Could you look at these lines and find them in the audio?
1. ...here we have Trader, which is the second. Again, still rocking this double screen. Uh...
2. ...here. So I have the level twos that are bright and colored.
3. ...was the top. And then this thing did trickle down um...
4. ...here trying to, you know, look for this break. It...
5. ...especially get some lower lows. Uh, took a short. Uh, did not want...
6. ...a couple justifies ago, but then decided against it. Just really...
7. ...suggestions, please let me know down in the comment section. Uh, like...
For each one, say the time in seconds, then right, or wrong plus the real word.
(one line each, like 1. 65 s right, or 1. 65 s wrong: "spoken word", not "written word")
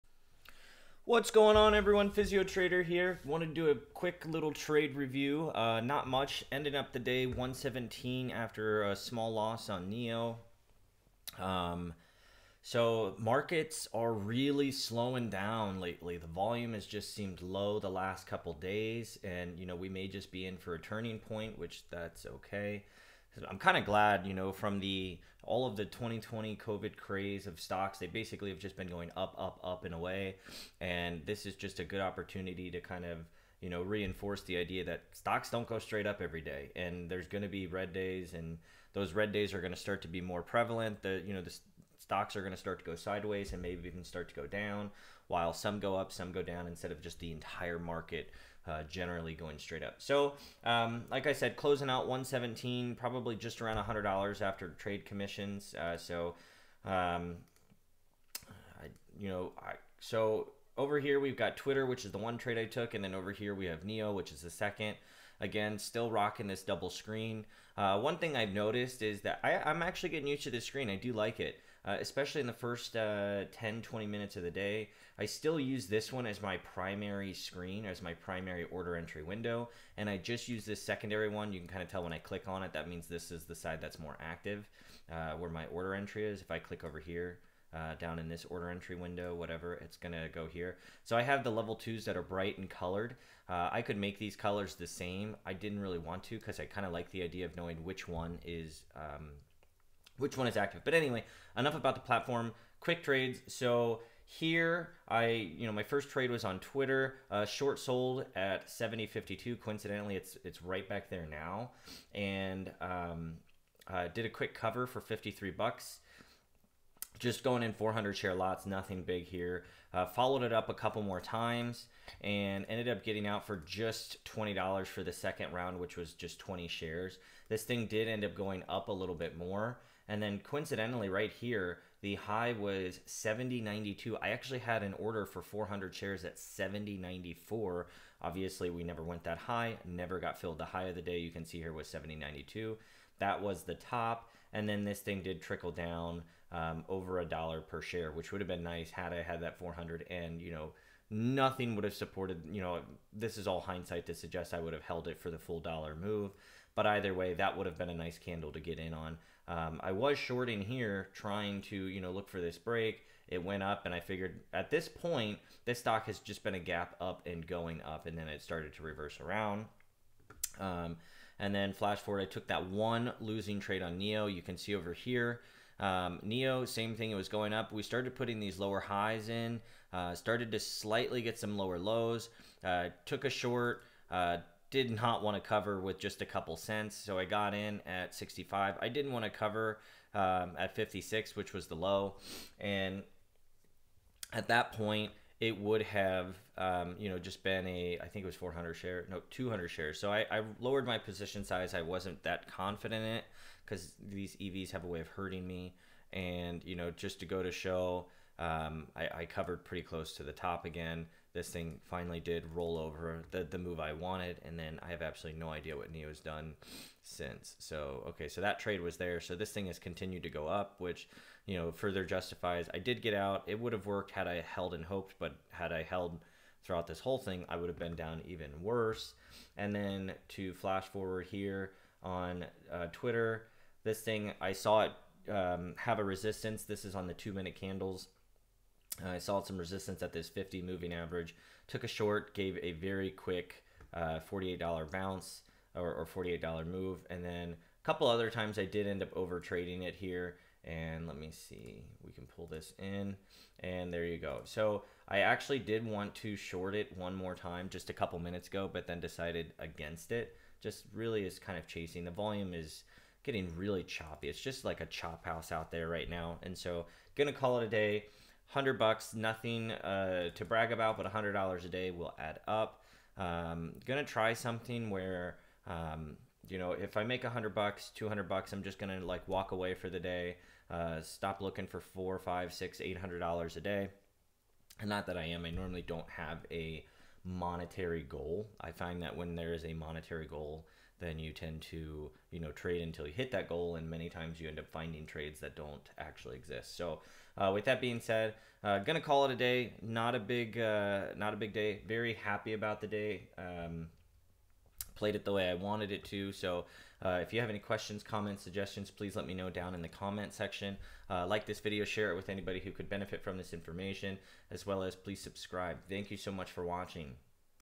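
1. 63 s wrong: "NIO", not "Trader"
2. 90 s right
3. 143 s right
4. 160 s right
5. 180 s wrong: "slightly", not "especially"
6. 257 s wrong: "minutes", not "justifies"
7. 308 s right.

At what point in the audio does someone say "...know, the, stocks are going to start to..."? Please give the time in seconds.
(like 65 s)
41 s.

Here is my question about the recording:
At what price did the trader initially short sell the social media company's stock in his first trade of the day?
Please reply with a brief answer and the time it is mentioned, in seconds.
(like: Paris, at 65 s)
70.52, at 108 s.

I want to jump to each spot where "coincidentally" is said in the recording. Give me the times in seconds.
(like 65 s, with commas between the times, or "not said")
109 s, 130 s.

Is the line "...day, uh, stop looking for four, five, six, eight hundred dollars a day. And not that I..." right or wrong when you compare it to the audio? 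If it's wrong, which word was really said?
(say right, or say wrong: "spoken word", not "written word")
right.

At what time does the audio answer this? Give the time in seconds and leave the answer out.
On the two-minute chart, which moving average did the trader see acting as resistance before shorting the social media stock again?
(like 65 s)
240 s.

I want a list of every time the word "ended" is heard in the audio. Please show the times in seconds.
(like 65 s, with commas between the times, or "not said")
6 s, 122 s.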